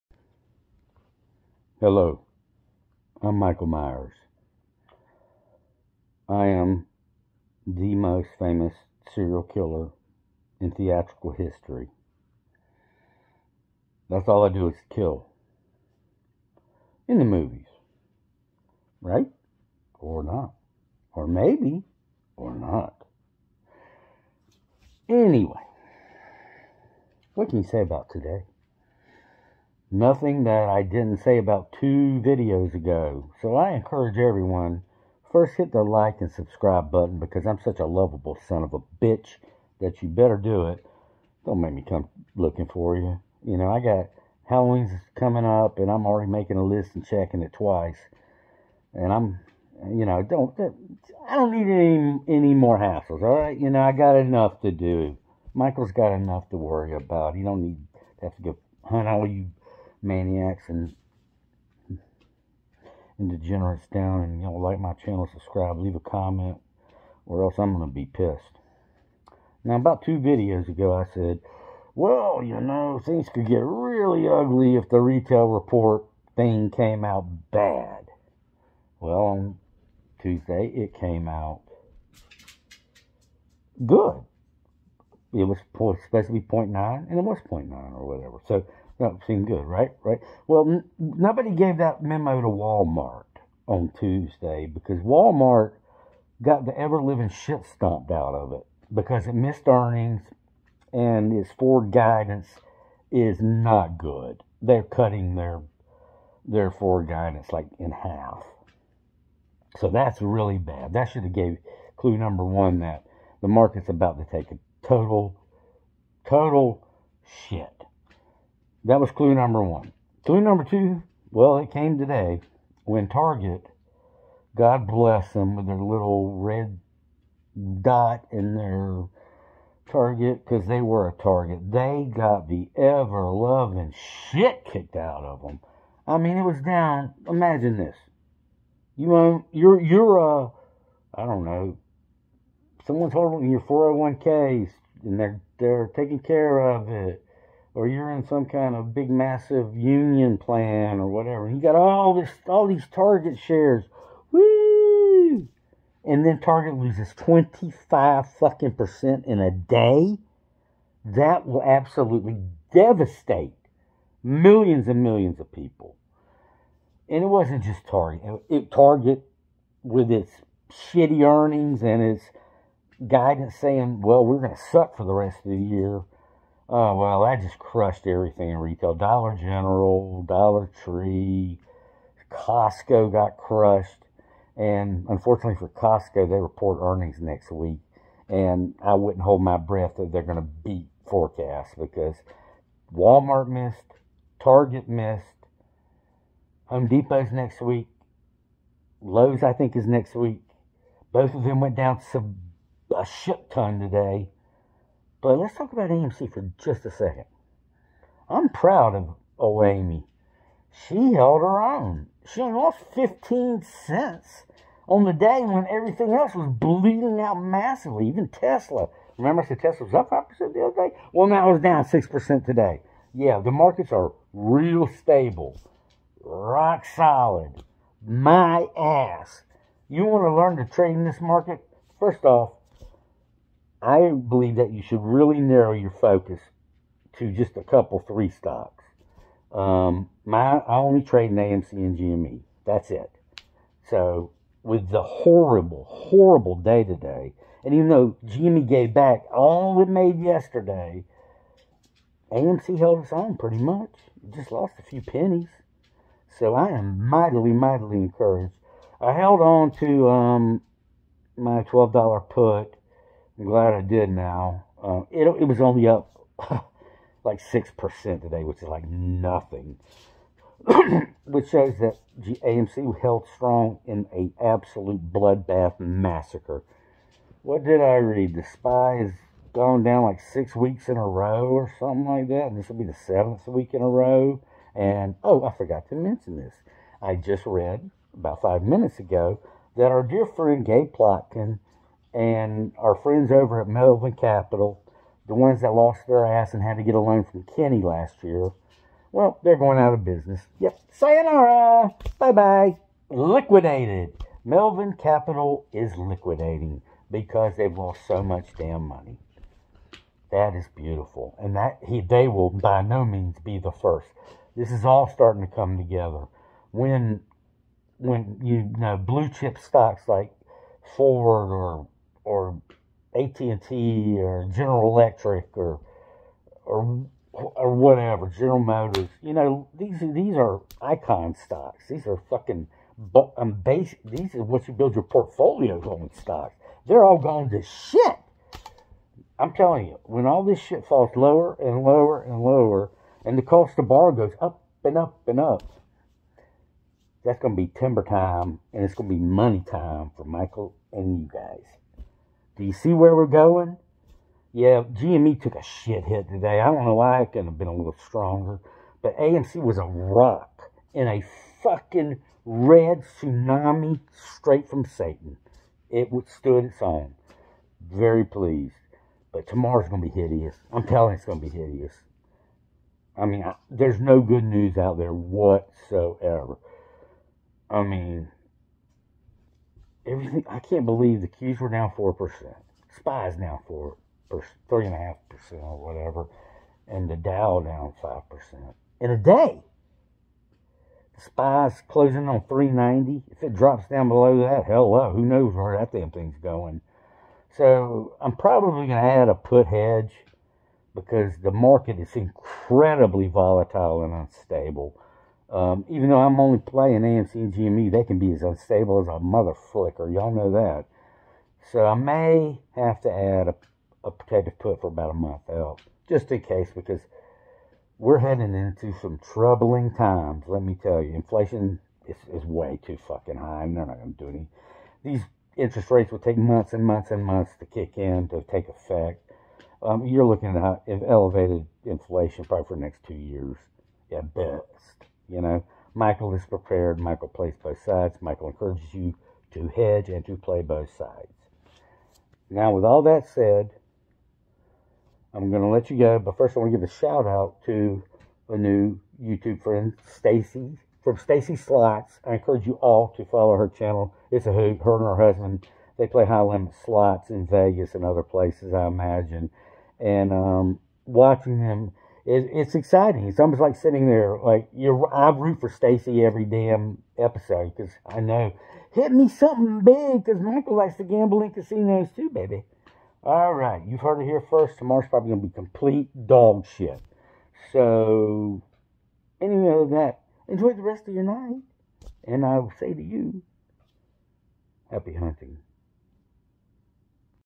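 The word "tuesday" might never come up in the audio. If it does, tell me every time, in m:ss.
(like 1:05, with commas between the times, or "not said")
1:20, 1:33.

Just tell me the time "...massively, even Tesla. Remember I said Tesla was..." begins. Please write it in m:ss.
3:37.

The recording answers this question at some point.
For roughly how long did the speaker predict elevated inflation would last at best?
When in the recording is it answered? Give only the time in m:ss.
7:13.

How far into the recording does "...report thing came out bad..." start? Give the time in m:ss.
1:15.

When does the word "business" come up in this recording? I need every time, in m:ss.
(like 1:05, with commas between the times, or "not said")
5:00.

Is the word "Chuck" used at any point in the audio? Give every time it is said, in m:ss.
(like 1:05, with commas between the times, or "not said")
not said.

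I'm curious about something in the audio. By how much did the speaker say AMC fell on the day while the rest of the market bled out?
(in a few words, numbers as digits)
15 cents.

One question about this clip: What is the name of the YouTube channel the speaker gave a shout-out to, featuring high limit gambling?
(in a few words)
Stacy Slots.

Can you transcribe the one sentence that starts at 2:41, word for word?
That will absolutely devastate millions and millions of people.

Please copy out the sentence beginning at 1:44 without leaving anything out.
They're cutting their their forward guidance like in half.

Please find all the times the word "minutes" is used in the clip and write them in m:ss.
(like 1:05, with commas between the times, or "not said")
4:48.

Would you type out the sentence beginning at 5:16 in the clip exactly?
When when you know blue chip stocks like Ford or or AT&T or General Electric or or or whatever, General Motors.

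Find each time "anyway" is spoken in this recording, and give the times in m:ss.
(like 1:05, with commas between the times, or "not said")
0:25, 7:59.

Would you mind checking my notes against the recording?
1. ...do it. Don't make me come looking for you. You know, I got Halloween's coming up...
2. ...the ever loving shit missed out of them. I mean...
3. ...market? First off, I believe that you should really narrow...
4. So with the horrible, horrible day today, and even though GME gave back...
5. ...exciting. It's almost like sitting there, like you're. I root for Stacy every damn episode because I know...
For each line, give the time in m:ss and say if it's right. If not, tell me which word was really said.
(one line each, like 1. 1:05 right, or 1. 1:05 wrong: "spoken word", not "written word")
1. 0:40 right
2. 2:12 wrong: "kicked", not "missed"
3. 3:51 right
4. 4:03 right
5. 7:42 right.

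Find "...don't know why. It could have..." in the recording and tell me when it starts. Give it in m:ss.
5:56.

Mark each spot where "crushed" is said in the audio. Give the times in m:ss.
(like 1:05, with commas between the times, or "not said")
2:57, 3:03.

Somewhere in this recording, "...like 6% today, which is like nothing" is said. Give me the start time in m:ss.
4:27.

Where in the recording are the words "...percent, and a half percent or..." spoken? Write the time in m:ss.
6:24.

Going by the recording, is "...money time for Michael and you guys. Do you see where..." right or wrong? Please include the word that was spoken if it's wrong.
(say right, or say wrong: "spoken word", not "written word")
right.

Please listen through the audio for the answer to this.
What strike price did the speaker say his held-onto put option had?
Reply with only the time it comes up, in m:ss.
4:21.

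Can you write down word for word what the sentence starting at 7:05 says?
These interest rates will take months and months and months to kick in to take effect.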